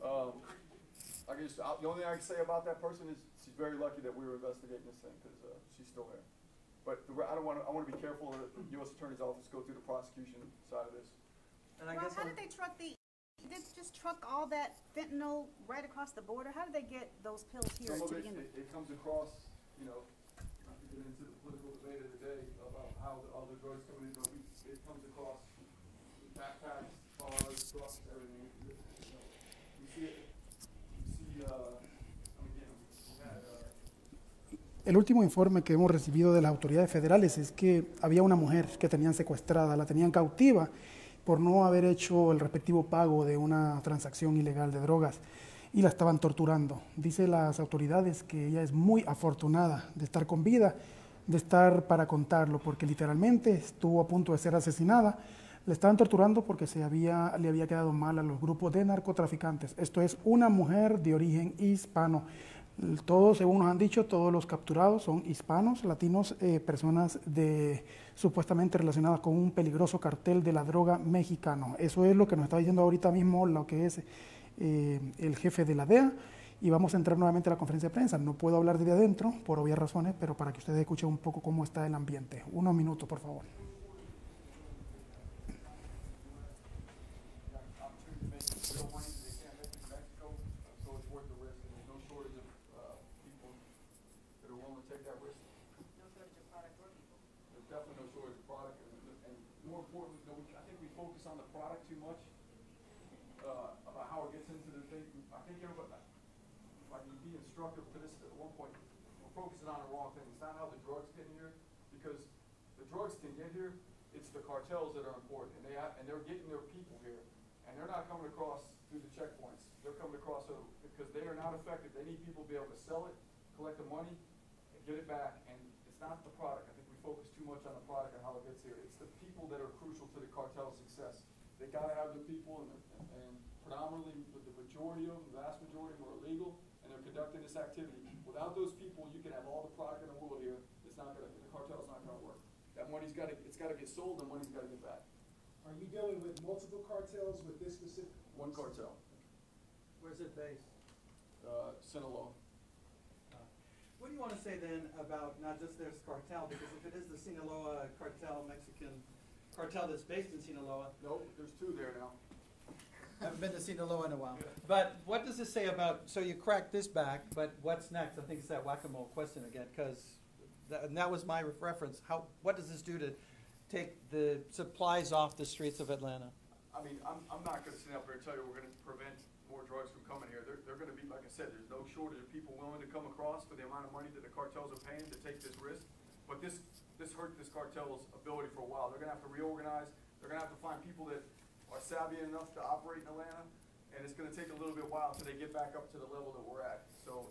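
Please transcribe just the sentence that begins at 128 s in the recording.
It's the people that are crucial to the cartel's success.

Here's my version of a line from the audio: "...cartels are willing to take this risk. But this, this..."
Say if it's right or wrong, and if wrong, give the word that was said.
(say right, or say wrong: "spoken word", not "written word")
wrong: "paying", not "willing".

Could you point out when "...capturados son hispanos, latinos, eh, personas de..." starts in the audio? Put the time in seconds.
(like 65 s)
64 s.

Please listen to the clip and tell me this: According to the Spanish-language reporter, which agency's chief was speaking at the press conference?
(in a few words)
DEA.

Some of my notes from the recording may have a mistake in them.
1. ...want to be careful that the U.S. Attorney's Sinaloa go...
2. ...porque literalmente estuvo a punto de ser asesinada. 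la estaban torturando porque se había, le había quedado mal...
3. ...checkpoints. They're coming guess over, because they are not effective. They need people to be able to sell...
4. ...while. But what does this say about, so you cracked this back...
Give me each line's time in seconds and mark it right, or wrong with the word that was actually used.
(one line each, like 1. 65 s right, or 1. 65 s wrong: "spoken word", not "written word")
1. 7 s wrong: "Office", not "Sinaloa"
2. 52 s right
3. 119 s wrong: "across", not "guess"
4. 164 s right.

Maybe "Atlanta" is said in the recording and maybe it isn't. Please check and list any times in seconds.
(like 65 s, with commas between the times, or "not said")
175 s, 193 s.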